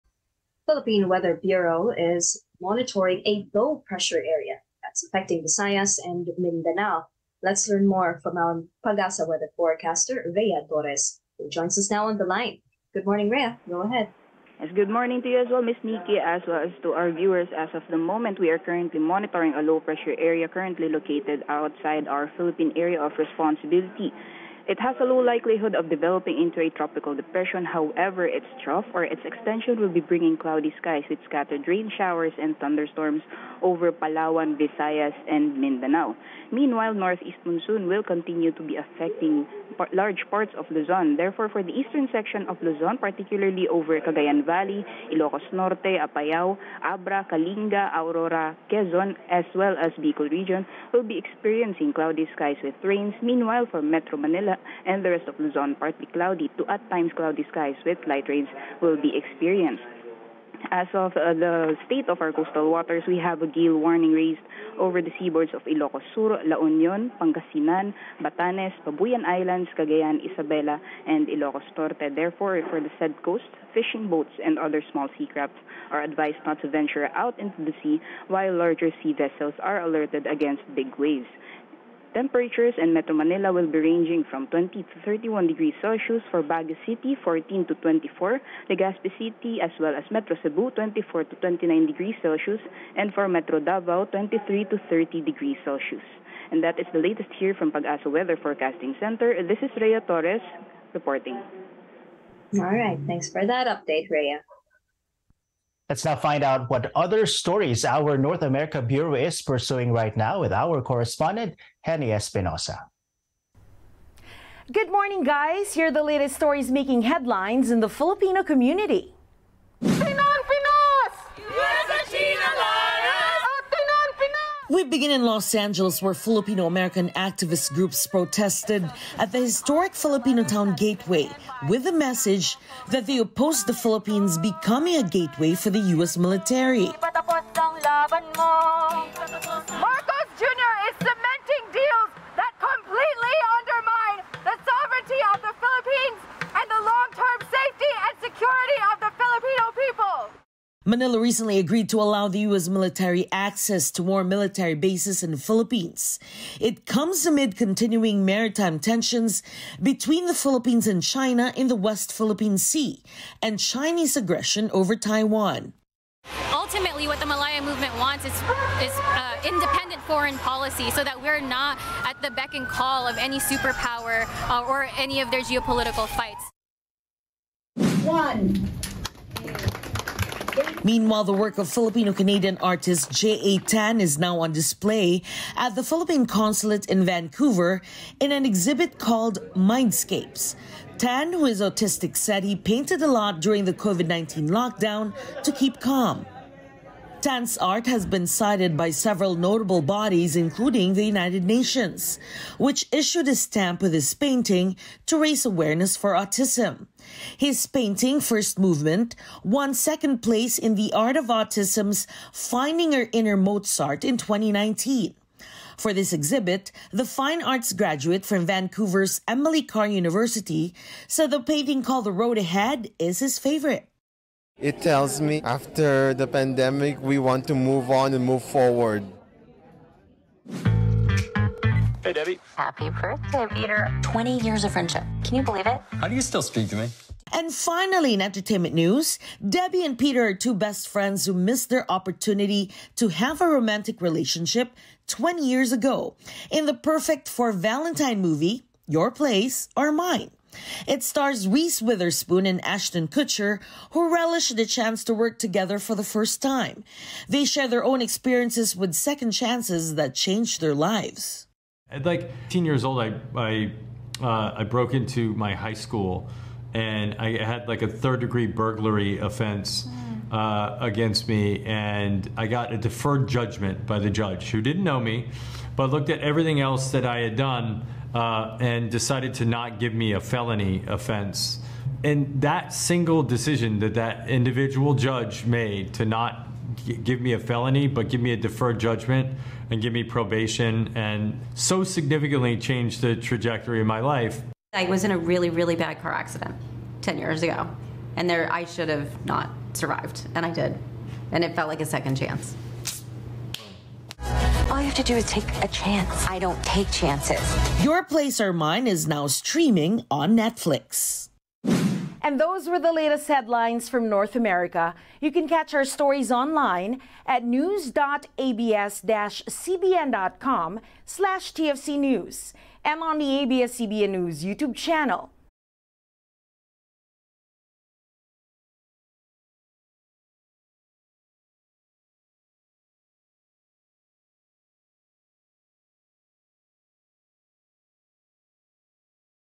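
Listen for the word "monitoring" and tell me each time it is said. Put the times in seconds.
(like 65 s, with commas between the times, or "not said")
2 s, 18 s.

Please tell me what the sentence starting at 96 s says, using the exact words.
And that is the latest here from Pag-asa Weather Forecasting Center.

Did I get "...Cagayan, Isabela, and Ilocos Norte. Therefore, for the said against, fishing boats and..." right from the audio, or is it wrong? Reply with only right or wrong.
wrong.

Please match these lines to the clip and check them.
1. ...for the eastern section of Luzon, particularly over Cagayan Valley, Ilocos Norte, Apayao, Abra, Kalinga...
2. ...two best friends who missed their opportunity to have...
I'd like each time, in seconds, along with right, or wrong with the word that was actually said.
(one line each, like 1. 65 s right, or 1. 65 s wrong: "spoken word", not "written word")
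1. 41 s right
2. 240 s right.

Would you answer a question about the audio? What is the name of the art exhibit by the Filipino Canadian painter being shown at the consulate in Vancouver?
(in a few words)
Mindscapes.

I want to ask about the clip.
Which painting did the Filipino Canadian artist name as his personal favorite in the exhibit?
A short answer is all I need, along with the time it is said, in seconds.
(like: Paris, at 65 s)
The Road Ahead, at 222 s.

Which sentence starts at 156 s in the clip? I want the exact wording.
It comes amid continuing maritime tensions between the Philippines and China in the West Philippine Sea and Chinese aggression over Taiwan.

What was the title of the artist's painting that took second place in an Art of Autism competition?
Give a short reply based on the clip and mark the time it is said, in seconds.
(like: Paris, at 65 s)
First Movement, at 208 s.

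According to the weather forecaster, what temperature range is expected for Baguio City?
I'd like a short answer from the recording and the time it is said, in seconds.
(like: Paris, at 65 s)
14 to 24, at 87 s.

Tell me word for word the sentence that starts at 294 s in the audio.
I was in a really, really bad car accident 10 years ago, and there I should have not survived, and I did.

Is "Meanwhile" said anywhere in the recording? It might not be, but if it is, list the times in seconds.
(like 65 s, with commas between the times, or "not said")
36 s, 53 s, 180 s.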